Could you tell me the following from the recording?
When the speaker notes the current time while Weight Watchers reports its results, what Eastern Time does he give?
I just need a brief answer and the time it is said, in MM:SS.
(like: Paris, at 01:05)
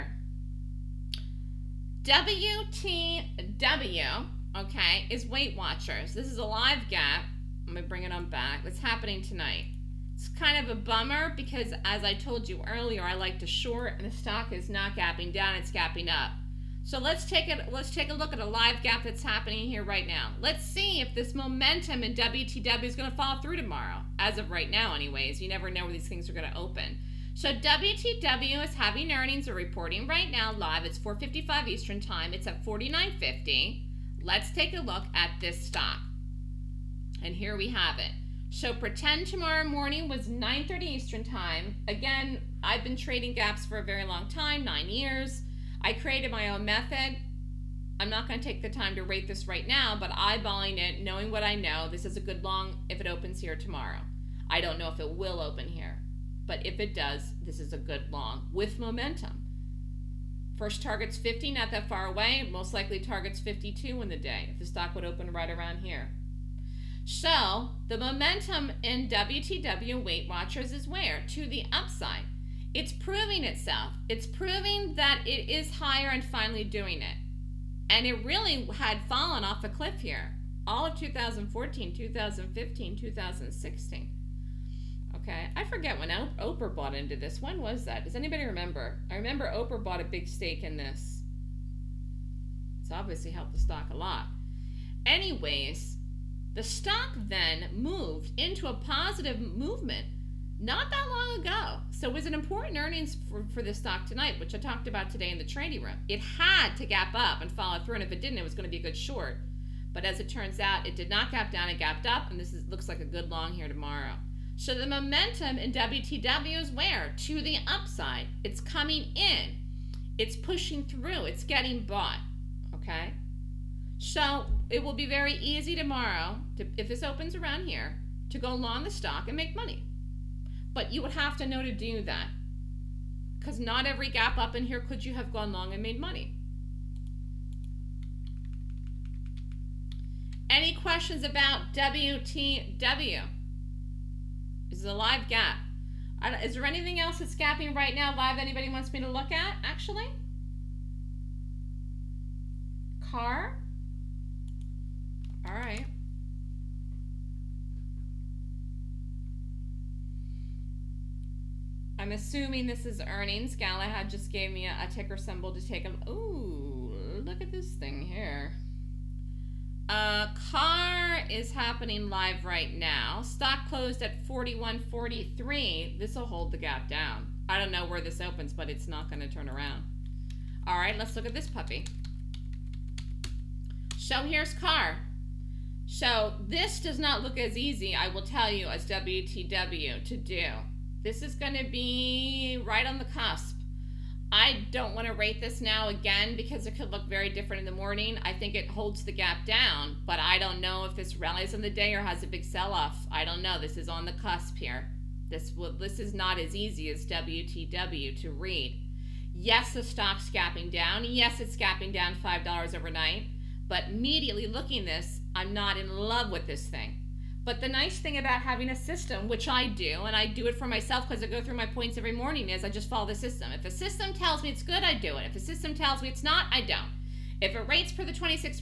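4:55, at 00:30.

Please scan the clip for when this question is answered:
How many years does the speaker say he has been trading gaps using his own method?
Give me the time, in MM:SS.
00:44.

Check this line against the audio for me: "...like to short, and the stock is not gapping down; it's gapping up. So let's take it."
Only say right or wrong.
right.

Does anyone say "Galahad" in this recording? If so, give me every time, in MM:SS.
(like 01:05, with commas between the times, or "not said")
02:43.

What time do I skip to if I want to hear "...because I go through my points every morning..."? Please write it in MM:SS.
03:41.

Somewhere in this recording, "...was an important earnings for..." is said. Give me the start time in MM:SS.
01:42.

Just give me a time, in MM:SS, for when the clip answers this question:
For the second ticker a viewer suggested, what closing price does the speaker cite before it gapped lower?
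02:54.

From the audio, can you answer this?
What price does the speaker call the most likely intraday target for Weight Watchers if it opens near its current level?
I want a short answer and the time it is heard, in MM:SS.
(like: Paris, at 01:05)
52, at 01:03.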